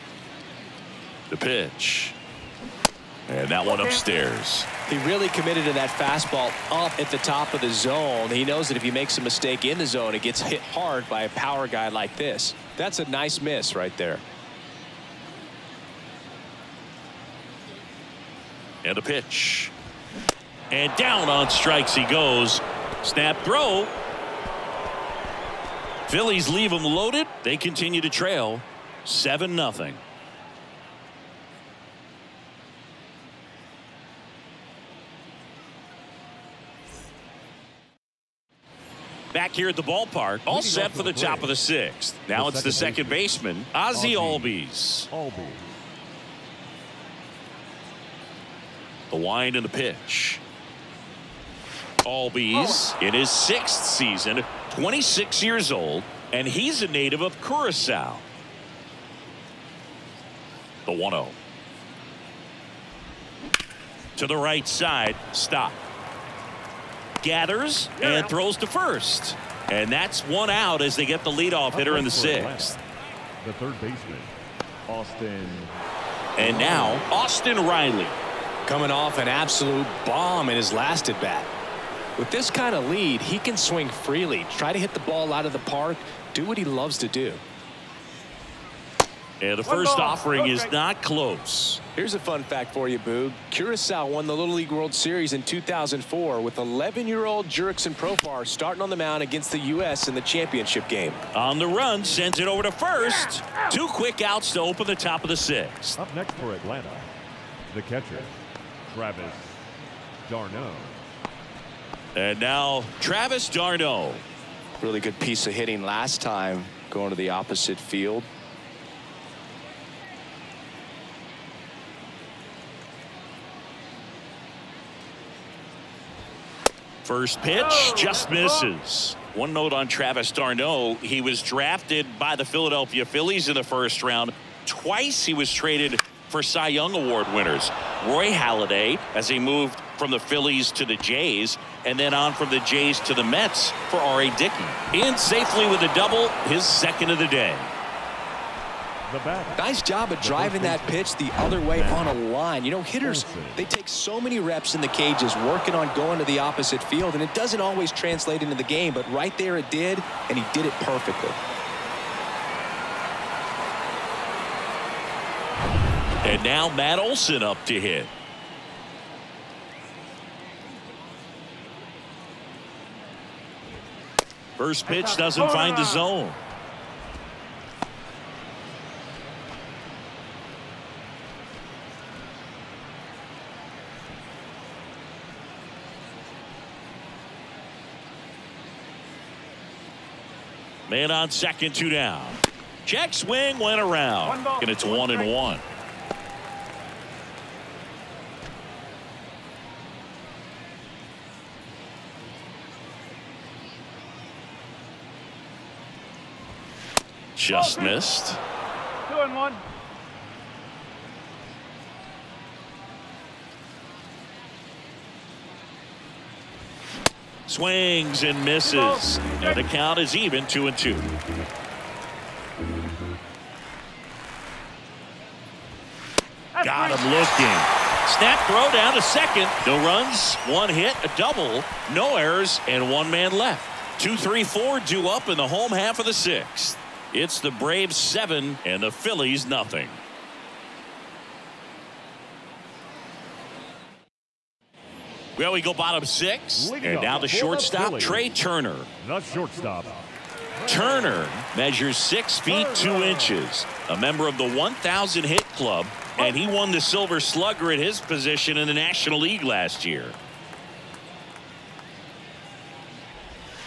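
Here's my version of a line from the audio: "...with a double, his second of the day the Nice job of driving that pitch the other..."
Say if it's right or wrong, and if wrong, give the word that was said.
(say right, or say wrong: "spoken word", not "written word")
right.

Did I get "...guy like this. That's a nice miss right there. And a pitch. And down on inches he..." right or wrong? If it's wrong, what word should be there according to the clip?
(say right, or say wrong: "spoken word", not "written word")
wrong: "strikes", not "inches".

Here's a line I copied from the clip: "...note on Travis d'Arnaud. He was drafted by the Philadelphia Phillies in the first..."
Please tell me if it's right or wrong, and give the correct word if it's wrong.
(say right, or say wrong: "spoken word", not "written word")
right.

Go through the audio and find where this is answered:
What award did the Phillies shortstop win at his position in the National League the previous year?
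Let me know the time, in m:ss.
4:16.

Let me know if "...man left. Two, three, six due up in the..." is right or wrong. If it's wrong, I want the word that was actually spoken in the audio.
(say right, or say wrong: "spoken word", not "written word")
wrong: "four", not "six".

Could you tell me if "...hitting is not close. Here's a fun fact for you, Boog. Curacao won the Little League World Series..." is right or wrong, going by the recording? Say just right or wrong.
wrong.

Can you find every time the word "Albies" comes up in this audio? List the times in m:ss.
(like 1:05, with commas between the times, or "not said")
0:44, 0:51.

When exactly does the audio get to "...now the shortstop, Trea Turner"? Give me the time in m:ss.
4:07.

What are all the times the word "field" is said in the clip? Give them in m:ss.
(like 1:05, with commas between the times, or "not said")
1:57, 2:36.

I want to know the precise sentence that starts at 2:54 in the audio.
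First pitch doesn't find the zone.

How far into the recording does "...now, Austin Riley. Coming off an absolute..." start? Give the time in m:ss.
1:16.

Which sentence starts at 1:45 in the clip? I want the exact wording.
Up next for Atlanta, the catcher, Travis d'Arnaud.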